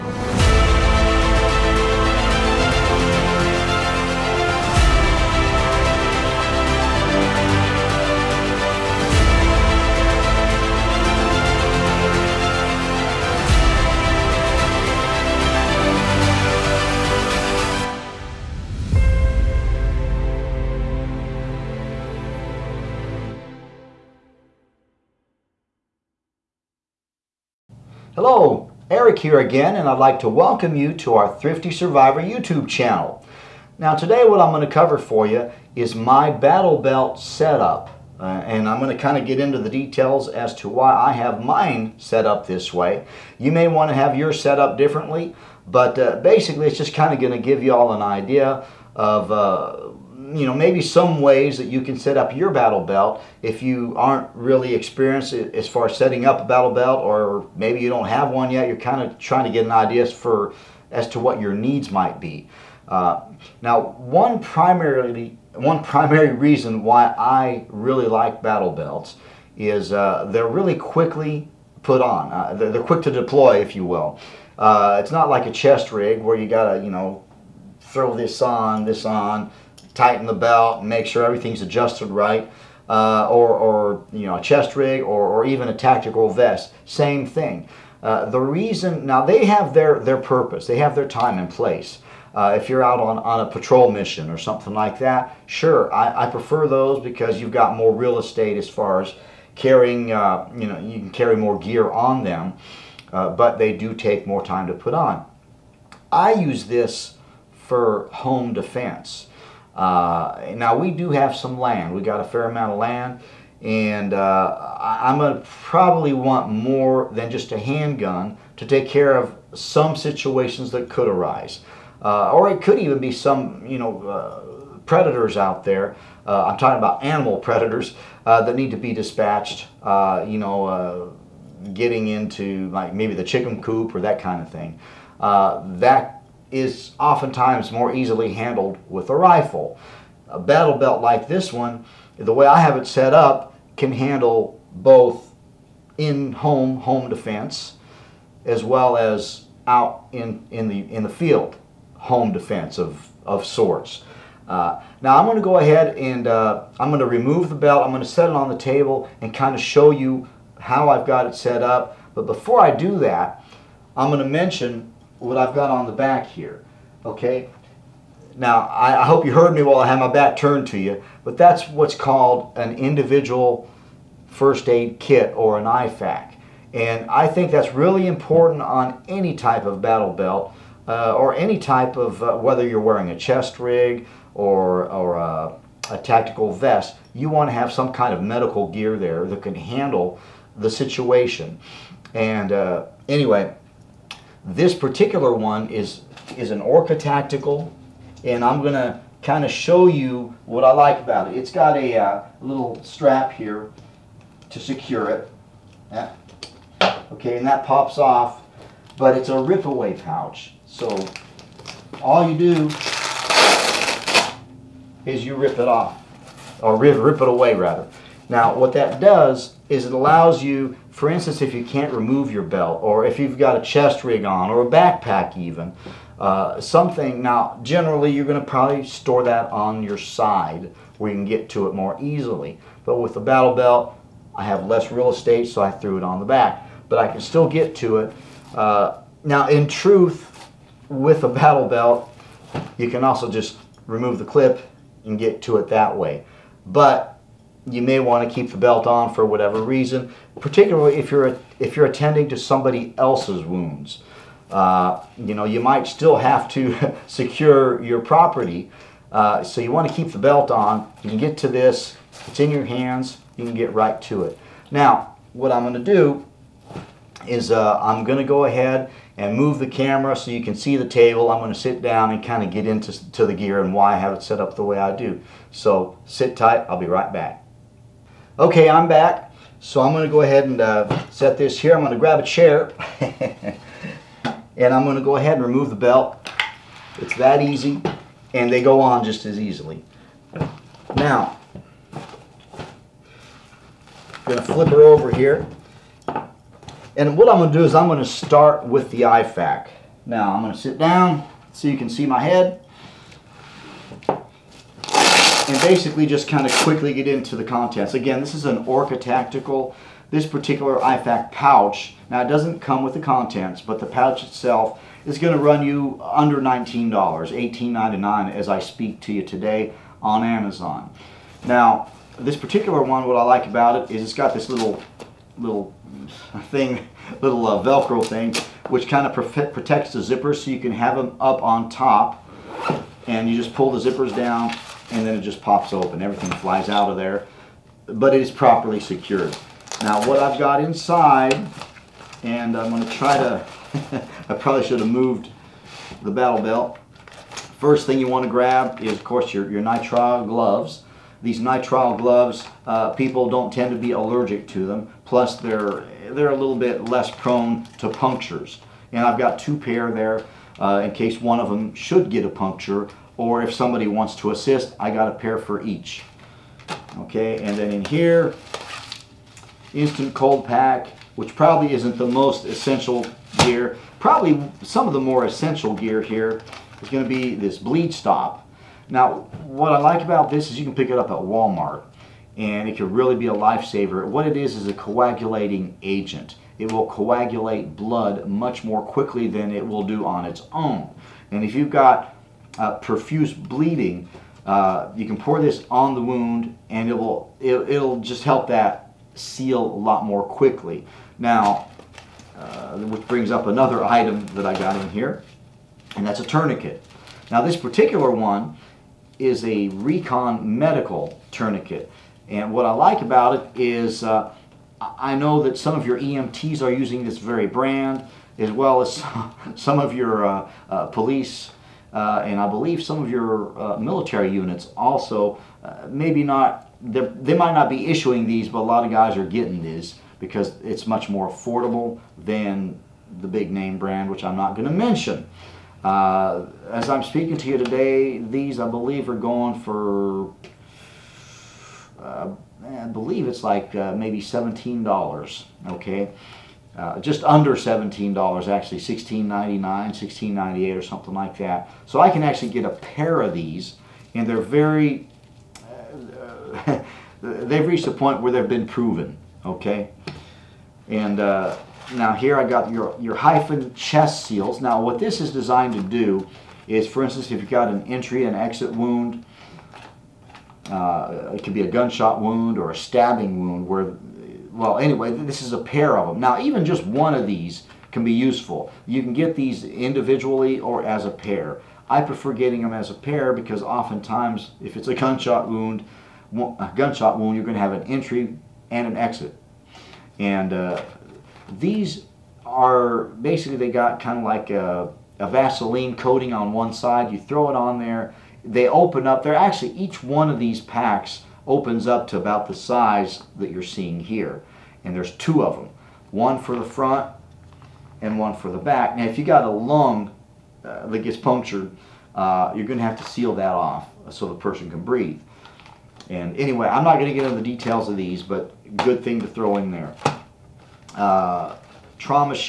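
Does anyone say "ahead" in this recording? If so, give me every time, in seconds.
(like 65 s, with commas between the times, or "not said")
155 s, 268 s, 280 s, 285 s.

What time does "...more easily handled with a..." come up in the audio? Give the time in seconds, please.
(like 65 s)
137 s.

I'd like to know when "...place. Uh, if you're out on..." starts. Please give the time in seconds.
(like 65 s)
91 s.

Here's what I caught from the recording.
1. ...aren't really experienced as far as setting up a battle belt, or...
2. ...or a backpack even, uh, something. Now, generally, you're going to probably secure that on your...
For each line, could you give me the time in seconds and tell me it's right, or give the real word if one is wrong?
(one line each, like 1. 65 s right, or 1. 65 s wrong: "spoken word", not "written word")
1. 53 s right
2. 224 s wrong: "store", not "secure".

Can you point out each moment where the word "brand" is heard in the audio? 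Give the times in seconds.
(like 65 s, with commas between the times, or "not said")
417 s, 433 s.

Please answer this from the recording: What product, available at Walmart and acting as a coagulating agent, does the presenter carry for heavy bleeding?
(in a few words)
bleed stop.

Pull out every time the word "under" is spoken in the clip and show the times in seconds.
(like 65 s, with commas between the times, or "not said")
316 s, 447 s.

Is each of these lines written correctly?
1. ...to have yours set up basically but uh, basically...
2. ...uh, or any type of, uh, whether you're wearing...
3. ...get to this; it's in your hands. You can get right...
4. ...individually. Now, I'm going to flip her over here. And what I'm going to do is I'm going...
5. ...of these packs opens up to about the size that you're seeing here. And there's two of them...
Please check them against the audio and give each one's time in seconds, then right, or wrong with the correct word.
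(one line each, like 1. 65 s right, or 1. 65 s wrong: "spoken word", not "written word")
1. 43 s wrong: "differently", not "basically"
2. 180 s right
3. 261 s right
4. 289 s wrong: "easily", not "individually"
5. 500 s right.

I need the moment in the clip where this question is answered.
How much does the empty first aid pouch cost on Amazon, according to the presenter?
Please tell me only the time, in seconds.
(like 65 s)
316 s.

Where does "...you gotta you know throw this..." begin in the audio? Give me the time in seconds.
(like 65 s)
76 s.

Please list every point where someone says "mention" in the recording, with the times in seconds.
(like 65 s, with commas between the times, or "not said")
164 s, 434 s.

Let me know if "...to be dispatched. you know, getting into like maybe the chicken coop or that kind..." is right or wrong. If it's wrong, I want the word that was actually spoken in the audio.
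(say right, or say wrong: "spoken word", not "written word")
right.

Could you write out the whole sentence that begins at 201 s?
It's got a uh, little strap here to secure it.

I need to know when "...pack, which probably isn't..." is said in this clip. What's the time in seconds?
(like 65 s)
370 s.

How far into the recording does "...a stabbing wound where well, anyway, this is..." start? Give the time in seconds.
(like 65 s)
472 s.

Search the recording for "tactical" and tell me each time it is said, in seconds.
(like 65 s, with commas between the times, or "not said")
85 s, 185 s, 196 s, 308 s.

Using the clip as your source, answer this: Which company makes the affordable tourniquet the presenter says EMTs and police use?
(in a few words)
Recon Medical.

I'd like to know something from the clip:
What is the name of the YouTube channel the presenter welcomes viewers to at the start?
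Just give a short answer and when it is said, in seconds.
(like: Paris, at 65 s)
Thrifty Survivor, at 31 s.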